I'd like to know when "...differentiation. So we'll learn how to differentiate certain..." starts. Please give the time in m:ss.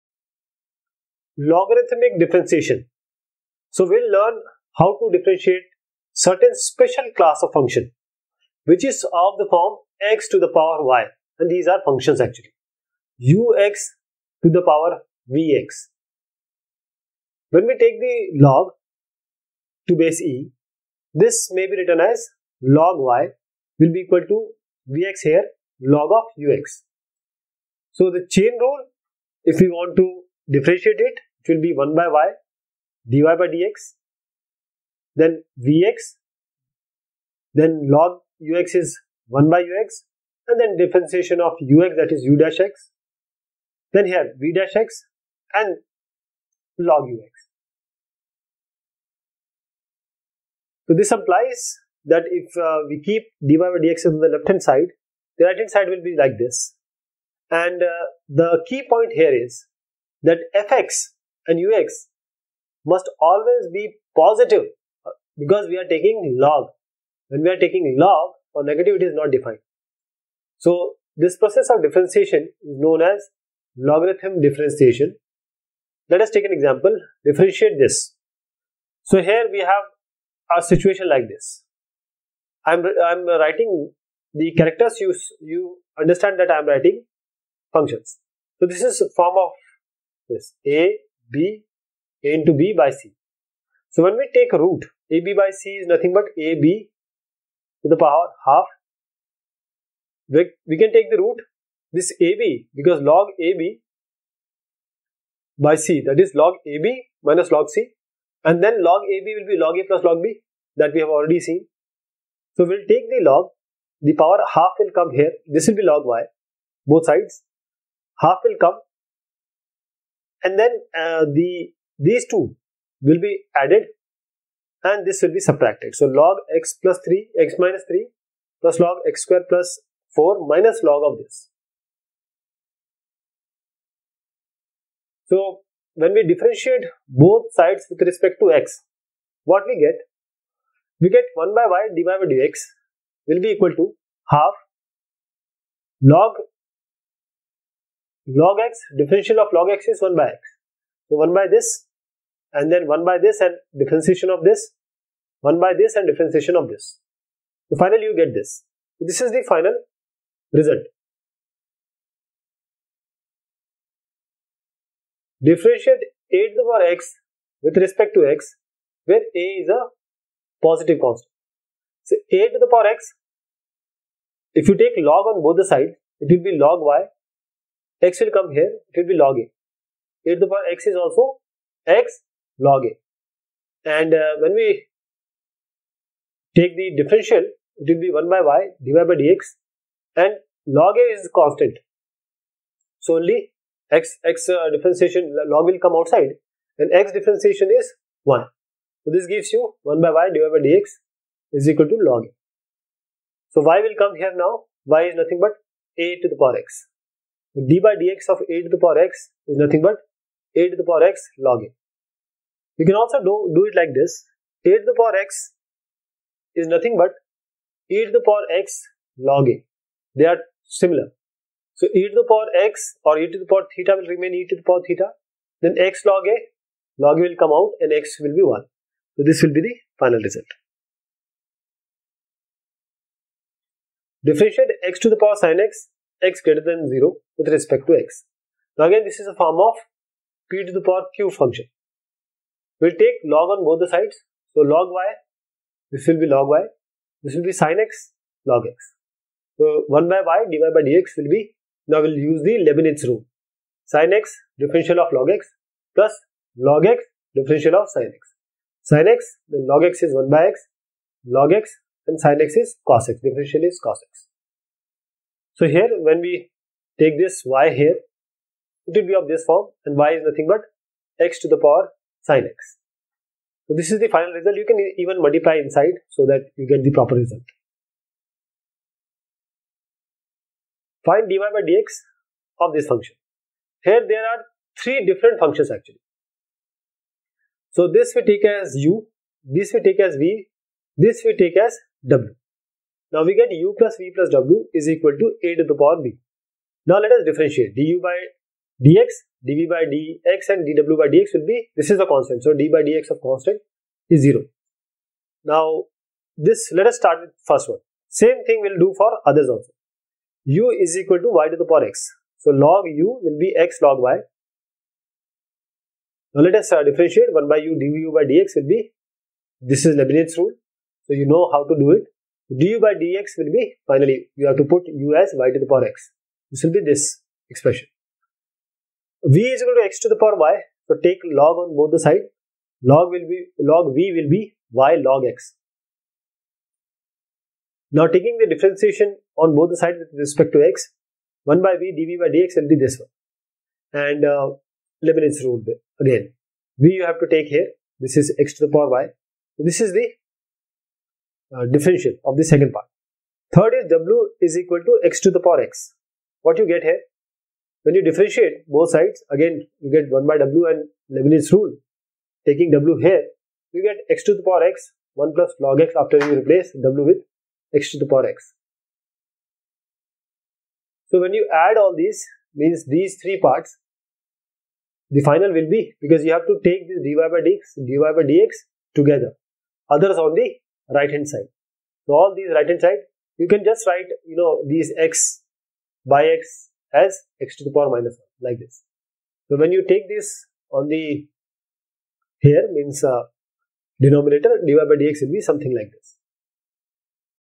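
0:02.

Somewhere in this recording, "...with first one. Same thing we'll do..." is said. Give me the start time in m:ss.
5:07.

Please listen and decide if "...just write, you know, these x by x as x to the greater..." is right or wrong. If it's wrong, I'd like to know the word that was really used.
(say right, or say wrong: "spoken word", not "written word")
wrong: "power", not "greater".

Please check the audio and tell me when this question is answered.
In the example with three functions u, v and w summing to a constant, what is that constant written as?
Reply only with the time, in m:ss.
4:55.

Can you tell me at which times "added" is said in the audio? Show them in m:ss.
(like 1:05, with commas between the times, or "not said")
2:03.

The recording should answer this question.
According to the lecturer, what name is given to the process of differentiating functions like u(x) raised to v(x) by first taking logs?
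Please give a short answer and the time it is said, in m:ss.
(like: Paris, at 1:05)
logarithm differentiation, at 1:13.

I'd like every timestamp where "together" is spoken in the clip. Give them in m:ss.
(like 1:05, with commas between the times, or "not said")
6:18.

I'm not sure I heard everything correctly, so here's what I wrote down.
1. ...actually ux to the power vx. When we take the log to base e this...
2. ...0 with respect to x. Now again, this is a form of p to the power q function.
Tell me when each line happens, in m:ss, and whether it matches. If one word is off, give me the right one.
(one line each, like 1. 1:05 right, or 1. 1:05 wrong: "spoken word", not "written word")
1. 0:12 right
2. 3:56 right.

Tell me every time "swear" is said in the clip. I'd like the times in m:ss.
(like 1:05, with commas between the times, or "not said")
not said.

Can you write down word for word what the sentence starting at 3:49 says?
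So this will be the final result.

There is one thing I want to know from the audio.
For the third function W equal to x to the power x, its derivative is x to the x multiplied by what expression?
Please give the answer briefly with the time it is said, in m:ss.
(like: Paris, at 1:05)
1 plus log x, at 6:05.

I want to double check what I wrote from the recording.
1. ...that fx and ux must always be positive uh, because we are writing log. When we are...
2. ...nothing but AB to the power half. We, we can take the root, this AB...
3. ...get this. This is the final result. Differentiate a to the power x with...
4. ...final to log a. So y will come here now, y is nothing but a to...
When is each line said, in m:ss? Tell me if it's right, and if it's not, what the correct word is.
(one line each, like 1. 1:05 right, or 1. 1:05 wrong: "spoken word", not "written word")
1. 1:00 wrong: "taking", not "writing"
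2. 1:35 right
3. 2:38 right
4. 3:21 wrong: "equal", not "final".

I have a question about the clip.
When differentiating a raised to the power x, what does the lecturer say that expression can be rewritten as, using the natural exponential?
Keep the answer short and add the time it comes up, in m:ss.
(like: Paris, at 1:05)
e to the power x log a, at 3:37.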